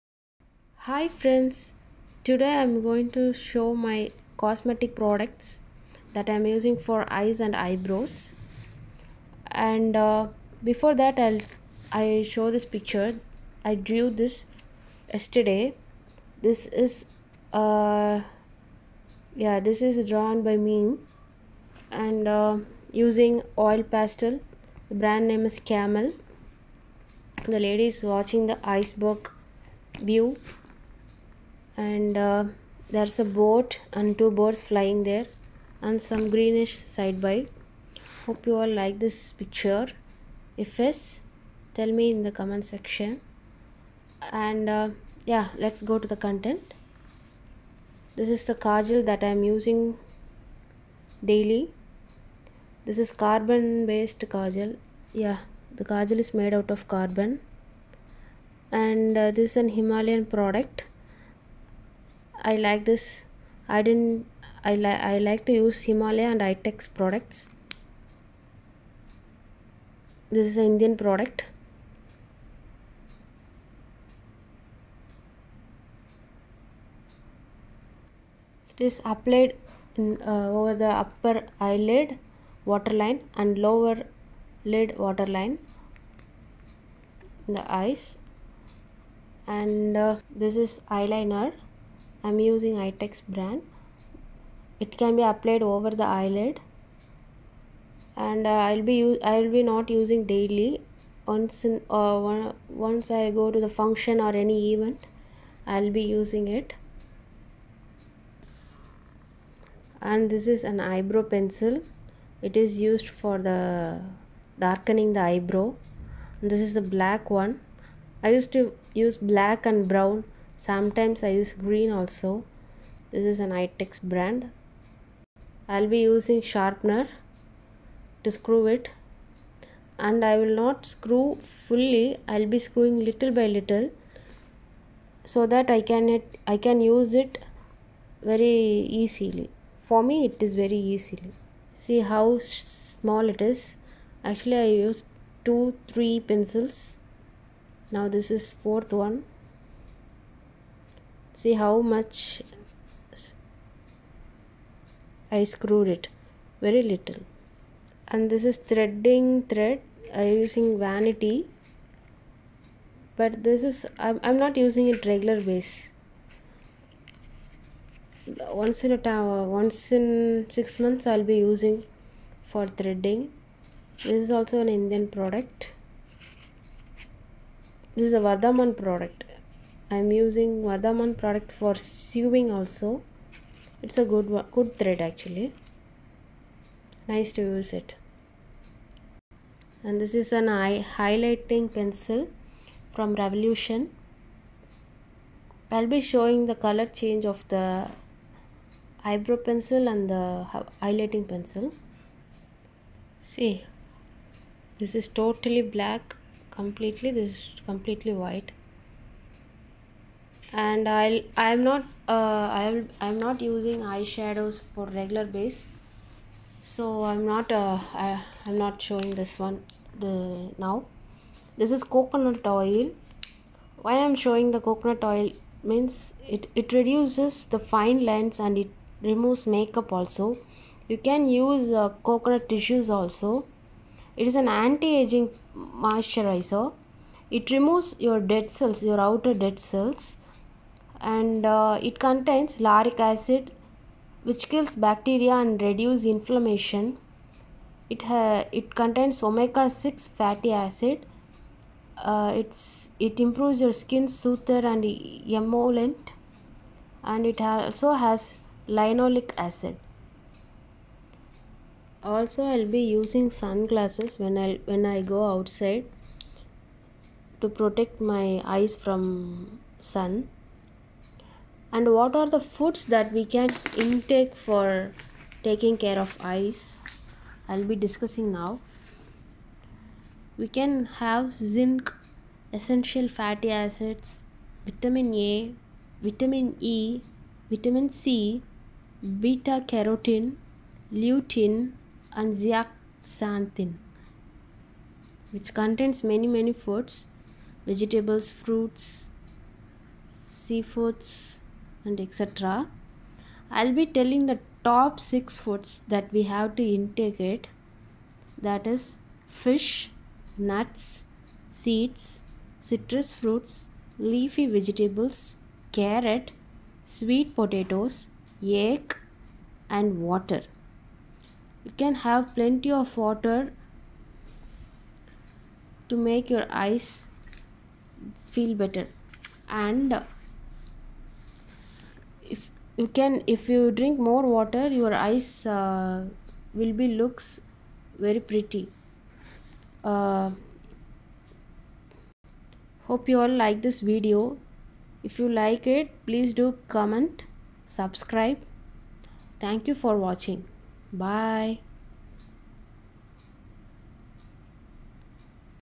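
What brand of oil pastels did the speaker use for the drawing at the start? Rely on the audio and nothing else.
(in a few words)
Camel.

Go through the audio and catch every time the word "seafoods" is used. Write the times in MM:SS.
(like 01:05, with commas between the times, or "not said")
05:00.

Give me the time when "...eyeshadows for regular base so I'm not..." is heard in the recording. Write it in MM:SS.
03:33.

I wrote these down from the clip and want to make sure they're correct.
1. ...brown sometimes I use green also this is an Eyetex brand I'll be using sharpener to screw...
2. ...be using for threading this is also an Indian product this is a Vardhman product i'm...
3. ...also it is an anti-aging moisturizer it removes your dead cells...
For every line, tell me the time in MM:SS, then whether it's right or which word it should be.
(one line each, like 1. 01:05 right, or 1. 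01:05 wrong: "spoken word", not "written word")
1. 01:59 right
2. 02:51 right
3. 03:52 right.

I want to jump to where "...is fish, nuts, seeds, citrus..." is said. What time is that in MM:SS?
05:08.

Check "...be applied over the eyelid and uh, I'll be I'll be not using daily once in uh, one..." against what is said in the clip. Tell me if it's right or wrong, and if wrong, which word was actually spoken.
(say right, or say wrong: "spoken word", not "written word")
right.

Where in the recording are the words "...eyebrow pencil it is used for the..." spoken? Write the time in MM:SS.
01:50.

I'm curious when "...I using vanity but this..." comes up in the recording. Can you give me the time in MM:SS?
02:40.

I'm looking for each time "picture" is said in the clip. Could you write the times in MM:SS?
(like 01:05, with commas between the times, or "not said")
00:12, 00:39.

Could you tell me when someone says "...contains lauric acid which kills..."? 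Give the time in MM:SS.
04:01.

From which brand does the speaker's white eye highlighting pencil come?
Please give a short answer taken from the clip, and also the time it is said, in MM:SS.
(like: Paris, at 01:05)
Revolution, at 03:13.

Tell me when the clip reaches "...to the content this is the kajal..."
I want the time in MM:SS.
00:45.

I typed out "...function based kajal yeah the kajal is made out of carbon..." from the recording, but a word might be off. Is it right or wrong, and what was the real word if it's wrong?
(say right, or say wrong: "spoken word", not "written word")
wrong: "carbon", not "function".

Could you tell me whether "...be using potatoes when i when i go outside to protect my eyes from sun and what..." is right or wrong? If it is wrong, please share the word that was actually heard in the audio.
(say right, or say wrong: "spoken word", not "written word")
wrong: "sunglasses", not "potatoes".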